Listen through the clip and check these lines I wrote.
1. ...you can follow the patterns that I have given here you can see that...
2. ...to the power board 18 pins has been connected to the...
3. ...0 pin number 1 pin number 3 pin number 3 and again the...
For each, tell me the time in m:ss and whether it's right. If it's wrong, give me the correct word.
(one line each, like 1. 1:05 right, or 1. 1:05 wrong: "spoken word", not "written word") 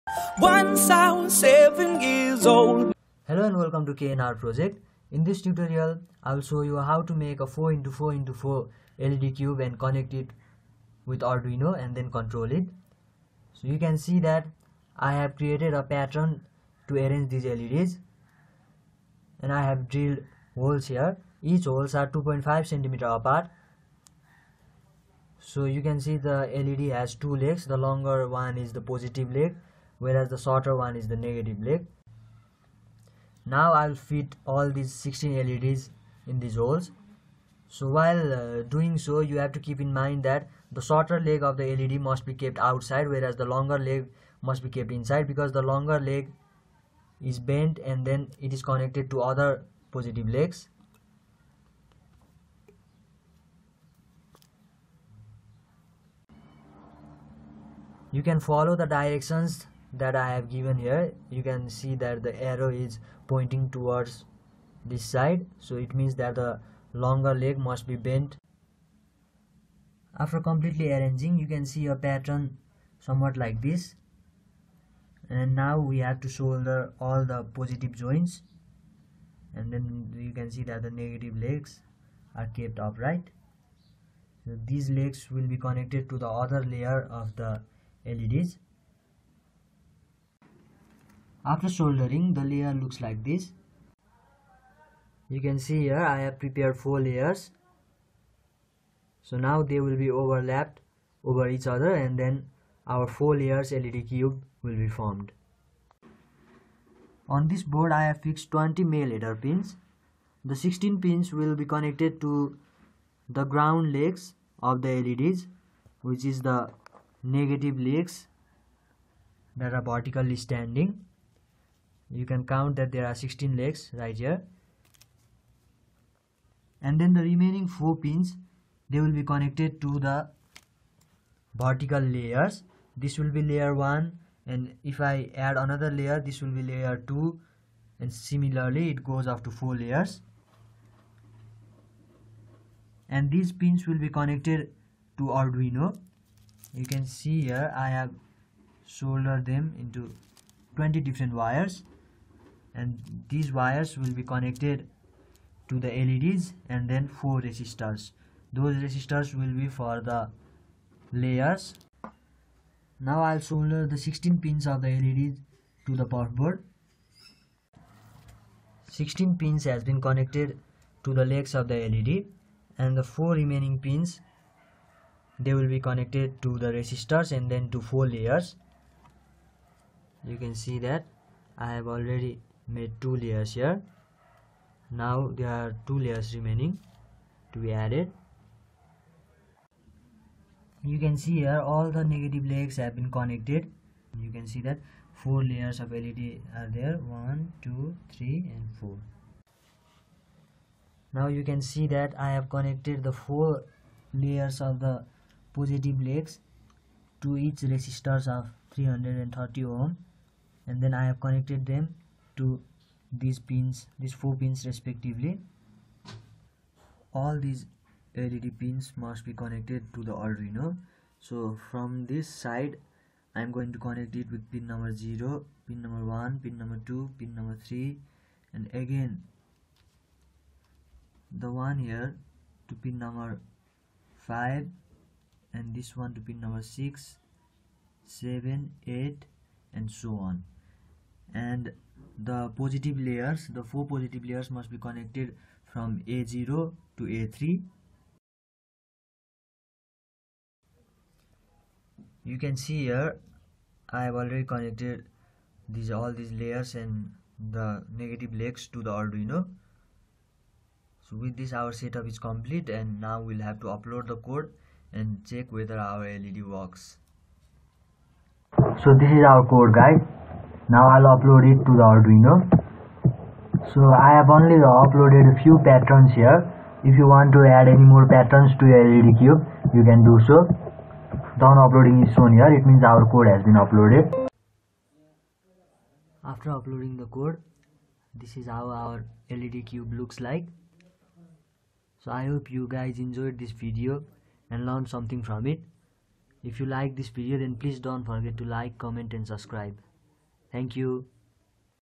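1. 0:58 wrong: "directions", not "patterns"
2. 2:45 wrong: "16", not "18"
3. 3:44 wrong: "2", not "3".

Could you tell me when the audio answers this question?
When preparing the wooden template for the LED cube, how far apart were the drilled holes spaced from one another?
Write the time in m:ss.
0:22.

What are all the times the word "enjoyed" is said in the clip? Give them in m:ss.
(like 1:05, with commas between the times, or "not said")
4:53.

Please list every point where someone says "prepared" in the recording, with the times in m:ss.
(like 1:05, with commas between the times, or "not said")
1:36.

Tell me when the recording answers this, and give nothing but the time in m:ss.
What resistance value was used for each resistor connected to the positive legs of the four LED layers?
3:28.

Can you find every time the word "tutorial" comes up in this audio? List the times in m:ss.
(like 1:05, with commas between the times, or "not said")
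0:05.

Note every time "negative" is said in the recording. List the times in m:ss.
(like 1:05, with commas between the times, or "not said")
0:31, 1:20, 1:57, 3:12, 4:17.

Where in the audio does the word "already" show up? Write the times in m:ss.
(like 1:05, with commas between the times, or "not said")
3:01, 4:14.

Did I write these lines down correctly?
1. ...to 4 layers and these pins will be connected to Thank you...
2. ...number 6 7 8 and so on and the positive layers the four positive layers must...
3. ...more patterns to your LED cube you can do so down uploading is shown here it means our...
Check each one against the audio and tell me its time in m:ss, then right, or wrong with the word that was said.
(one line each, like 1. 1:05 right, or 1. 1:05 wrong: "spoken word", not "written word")
1. 2:19 wrong: "Arduino", not "Thank"
2. 3:56 right
3. 4:37 right.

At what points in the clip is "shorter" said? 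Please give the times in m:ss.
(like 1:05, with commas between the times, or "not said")
0:30, 0:40.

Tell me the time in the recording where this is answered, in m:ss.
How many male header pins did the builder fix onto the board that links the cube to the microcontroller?
1:48.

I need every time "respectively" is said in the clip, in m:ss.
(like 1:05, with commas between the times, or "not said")
3:34.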